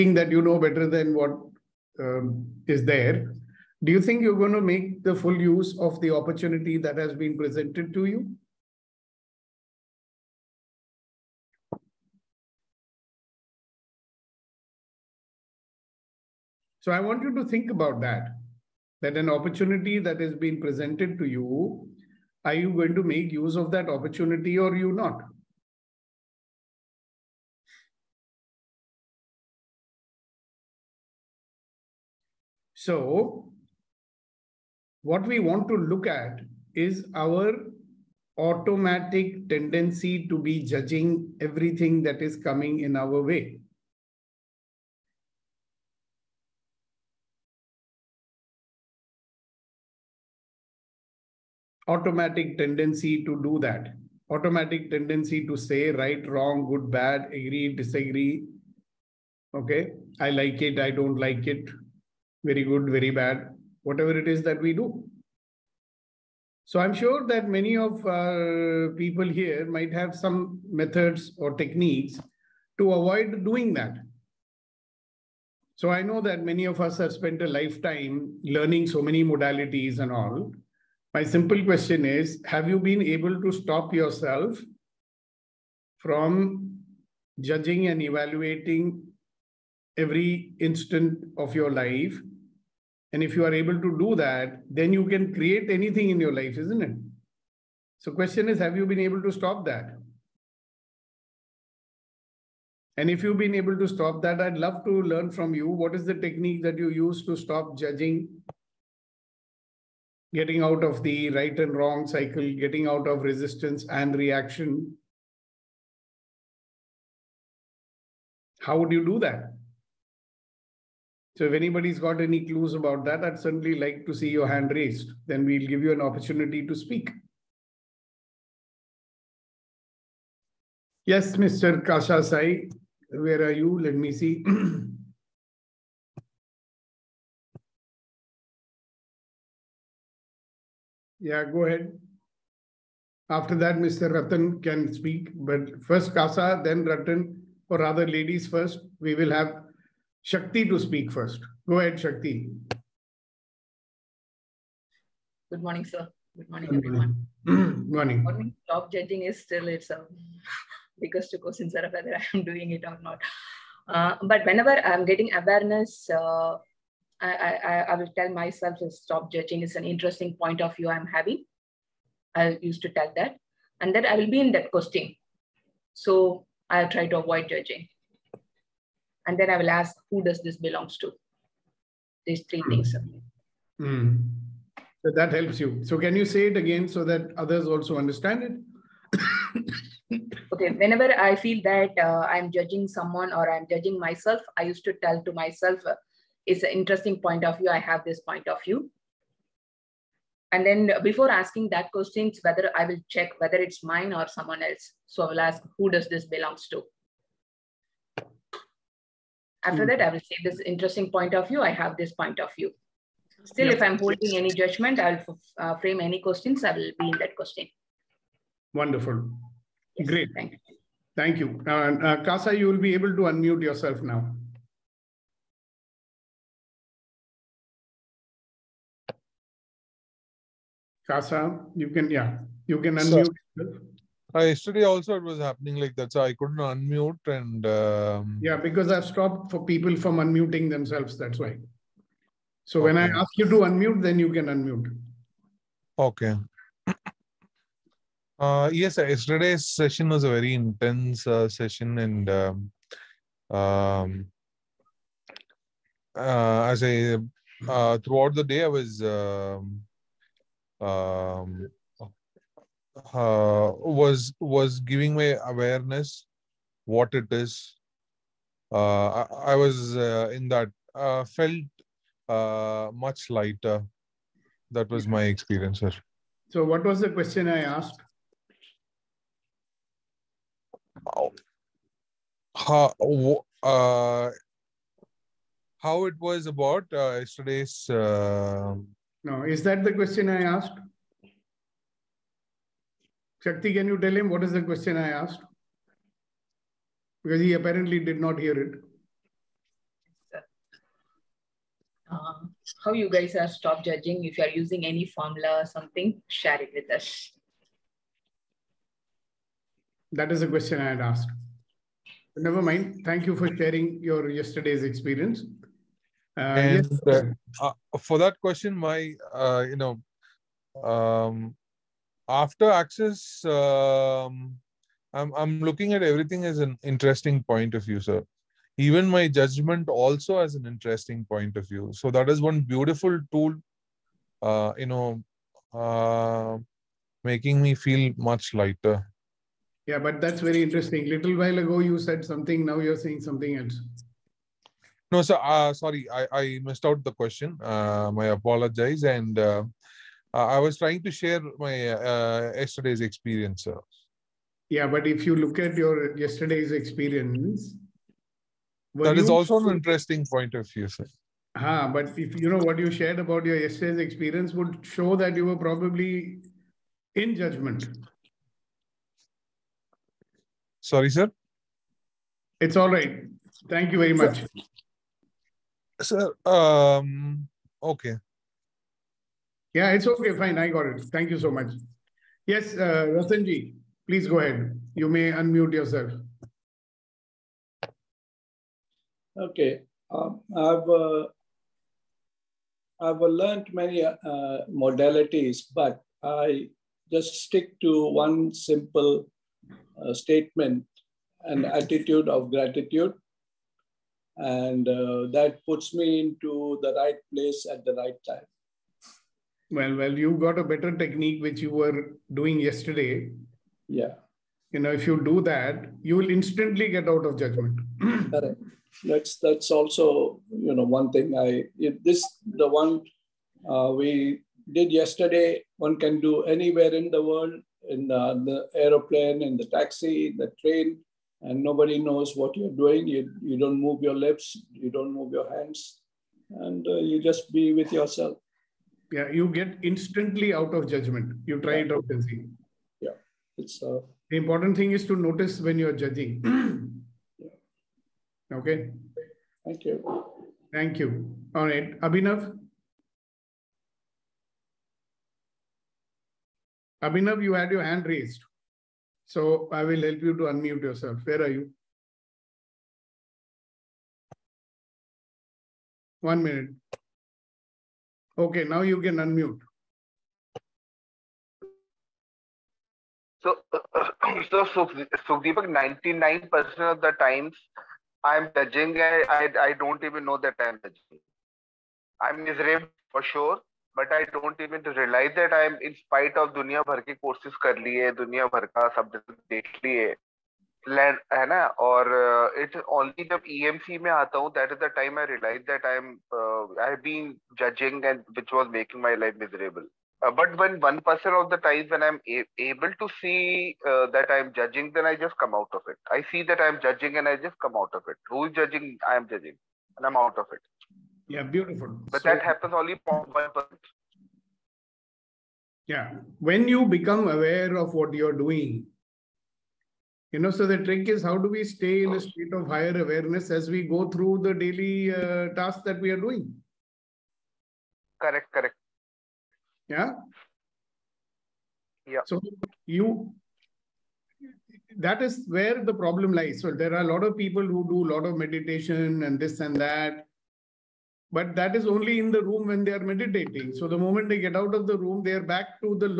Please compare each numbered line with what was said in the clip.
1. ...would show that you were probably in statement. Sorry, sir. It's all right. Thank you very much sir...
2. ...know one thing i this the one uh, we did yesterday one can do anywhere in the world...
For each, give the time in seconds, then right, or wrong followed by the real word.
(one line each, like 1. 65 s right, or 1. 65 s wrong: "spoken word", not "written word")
1. 364 s wrong: "judgment", not "statement"
2. 420 s right.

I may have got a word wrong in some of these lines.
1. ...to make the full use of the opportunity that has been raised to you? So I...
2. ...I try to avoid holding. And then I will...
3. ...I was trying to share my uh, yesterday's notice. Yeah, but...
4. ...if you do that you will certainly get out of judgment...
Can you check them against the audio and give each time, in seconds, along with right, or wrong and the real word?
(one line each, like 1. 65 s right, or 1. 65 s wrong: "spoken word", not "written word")
1. 4 s wrong: "presented", not "raised"
2. 176 s wrong: "judging", not "holding"
3. 350 s wrong: "experience", not "notice"
4. 414 s wrong: "instantly", not "certainly".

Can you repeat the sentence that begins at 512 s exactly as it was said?
But so, that happens only for one person.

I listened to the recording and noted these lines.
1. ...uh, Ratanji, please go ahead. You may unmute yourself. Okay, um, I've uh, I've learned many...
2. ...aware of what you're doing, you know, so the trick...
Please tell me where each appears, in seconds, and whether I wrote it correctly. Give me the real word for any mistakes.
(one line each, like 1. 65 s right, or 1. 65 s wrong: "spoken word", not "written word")
1. 382 s right
2. 517 s right.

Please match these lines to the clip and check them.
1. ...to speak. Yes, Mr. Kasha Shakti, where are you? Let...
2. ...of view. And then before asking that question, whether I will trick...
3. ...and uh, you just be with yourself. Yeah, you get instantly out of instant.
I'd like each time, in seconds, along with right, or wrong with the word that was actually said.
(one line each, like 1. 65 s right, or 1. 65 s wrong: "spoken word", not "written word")
1. 126 s wrong: "Sai", not "Shakti"
2. 198 s wrong: "check", not "trick"
3. 436 s wrong: "judgment", not "instant".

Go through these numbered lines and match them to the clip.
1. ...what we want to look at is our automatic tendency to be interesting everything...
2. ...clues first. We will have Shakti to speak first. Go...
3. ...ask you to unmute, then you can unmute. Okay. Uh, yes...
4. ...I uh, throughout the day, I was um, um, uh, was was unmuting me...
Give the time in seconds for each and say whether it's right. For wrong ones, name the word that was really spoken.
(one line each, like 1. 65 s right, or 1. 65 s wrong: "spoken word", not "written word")
1. 35 s wrong: "judging", not "interesting"
2. 148 s wrong: "ladies", not "clues"
3. 243 s right
4. 256 s wrong: "giving", not "unmuting".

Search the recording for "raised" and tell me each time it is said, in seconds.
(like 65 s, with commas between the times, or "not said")
124 s, 458 s.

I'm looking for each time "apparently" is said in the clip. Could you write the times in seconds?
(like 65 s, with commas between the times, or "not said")
297 s.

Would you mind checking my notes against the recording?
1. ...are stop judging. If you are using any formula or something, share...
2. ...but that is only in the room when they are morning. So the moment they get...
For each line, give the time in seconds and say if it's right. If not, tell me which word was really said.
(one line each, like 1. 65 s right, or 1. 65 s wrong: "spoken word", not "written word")
1. 303 s right
2. 541 s wrong: "meditating", not "morning".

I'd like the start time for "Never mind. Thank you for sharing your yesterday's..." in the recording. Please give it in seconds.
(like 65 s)
312 s.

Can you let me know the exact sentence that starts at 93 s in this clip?
And if you are able to do that, then you can create anything in your life, isn't it?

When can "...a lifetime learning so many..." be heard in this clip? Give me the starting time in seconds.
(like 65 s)
77 s.